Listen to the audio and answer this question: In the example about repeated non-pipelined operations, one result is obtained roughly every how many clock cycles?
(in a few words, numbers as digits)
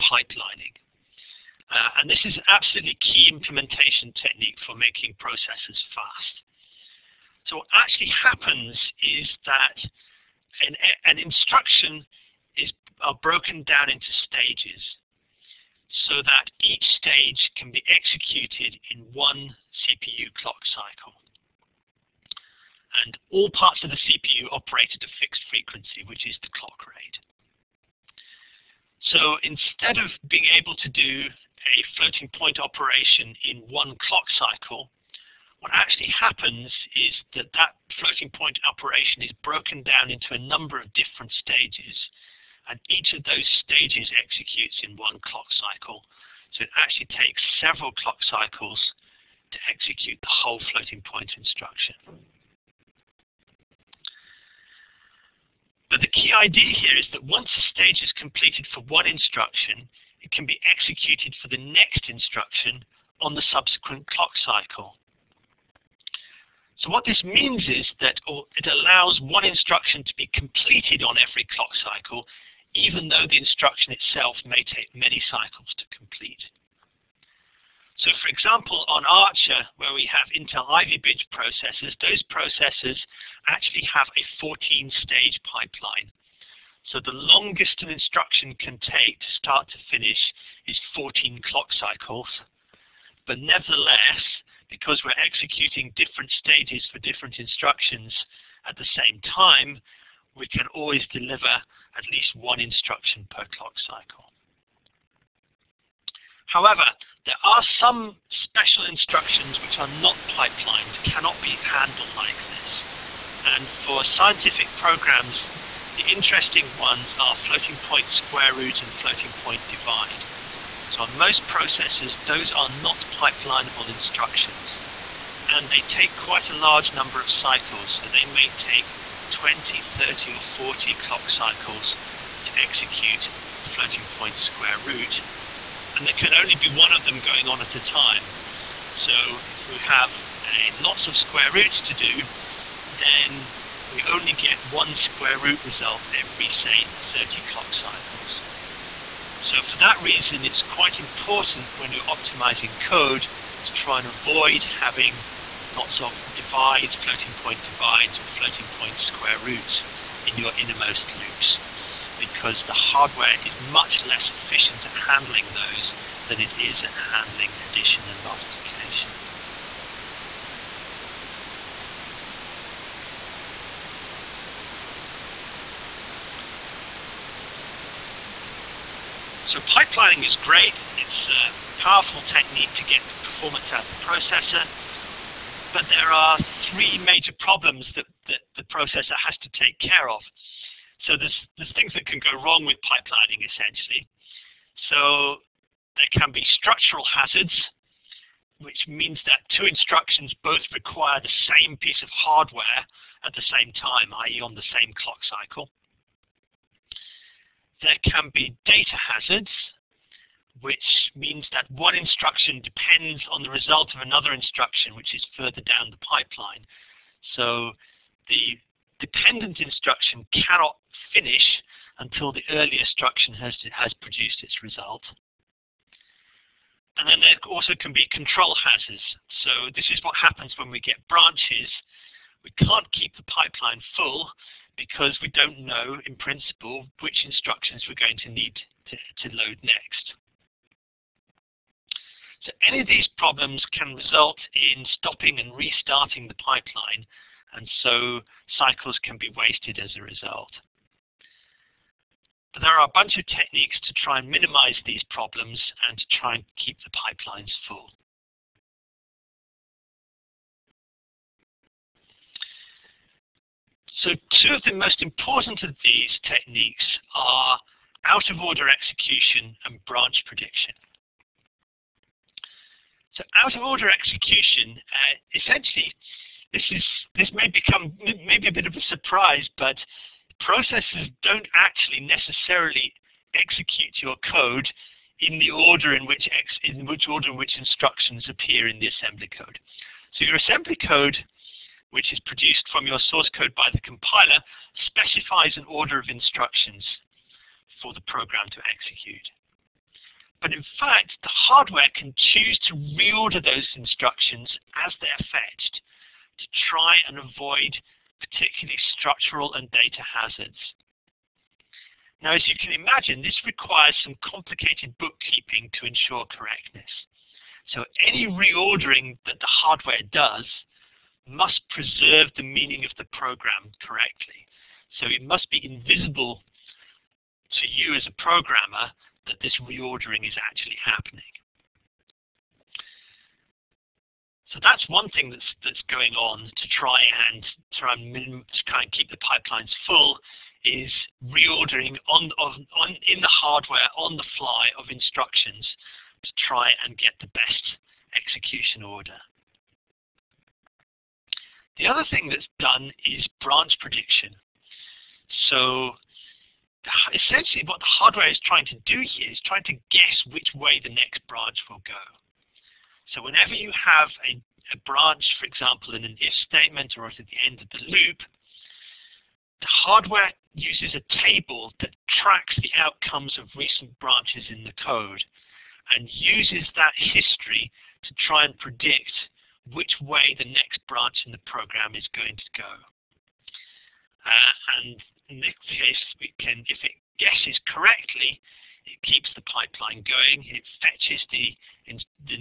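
30.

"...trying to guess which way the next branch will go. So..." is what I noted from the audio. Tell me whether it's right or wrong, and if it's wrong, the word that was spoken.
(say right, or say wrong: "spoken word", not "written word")
right.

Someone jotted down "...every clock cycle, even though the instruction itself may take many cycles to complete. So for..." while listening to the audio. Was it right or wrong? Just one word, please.
right.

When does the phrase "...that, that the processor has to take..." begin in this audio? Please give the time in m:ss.
3:07.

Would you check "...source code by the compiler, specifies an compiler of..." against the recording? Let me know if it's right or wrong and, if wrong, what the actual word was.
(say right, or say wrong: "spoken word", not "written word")
wrong: "order", not "compiler".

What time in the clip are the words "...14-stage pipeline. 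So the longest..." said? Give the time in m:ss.
1:24.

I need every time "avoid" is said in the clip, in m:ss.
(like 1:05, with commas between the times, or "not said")
2:34, 5:07.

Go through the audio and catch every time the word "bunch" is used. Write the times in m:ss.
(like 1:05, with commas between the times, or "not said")
4:12.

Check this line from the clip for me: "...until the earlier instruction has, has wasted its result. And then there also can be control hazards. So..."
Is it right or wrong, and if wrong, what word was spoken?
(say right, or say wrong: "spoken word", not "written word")
wrong: "produced", not "wasted".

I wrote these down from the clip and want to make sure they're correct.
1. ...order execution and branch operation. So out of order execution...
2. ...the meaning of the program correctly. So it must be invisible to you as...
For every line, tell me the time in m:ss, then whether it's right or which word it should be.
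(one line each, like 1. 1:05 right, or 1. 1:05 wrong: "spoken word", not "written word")
1. 4:28 wrong: "prediction", not "operation"
2. 5:22 right.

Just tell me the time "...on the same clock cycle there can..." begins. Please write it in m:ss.
3:24.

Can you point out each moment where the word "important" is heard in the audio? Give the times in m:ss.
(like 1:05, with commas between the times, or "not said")
2:30, 4:25.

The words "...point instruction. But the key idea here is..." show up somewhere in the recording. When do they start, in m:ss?
0:51.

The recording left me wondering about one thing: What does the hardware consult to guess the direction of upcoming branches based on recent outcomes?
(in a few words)
a table.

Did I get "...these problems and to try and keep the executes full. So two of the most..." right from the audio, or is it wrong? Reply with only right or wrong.
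wrong.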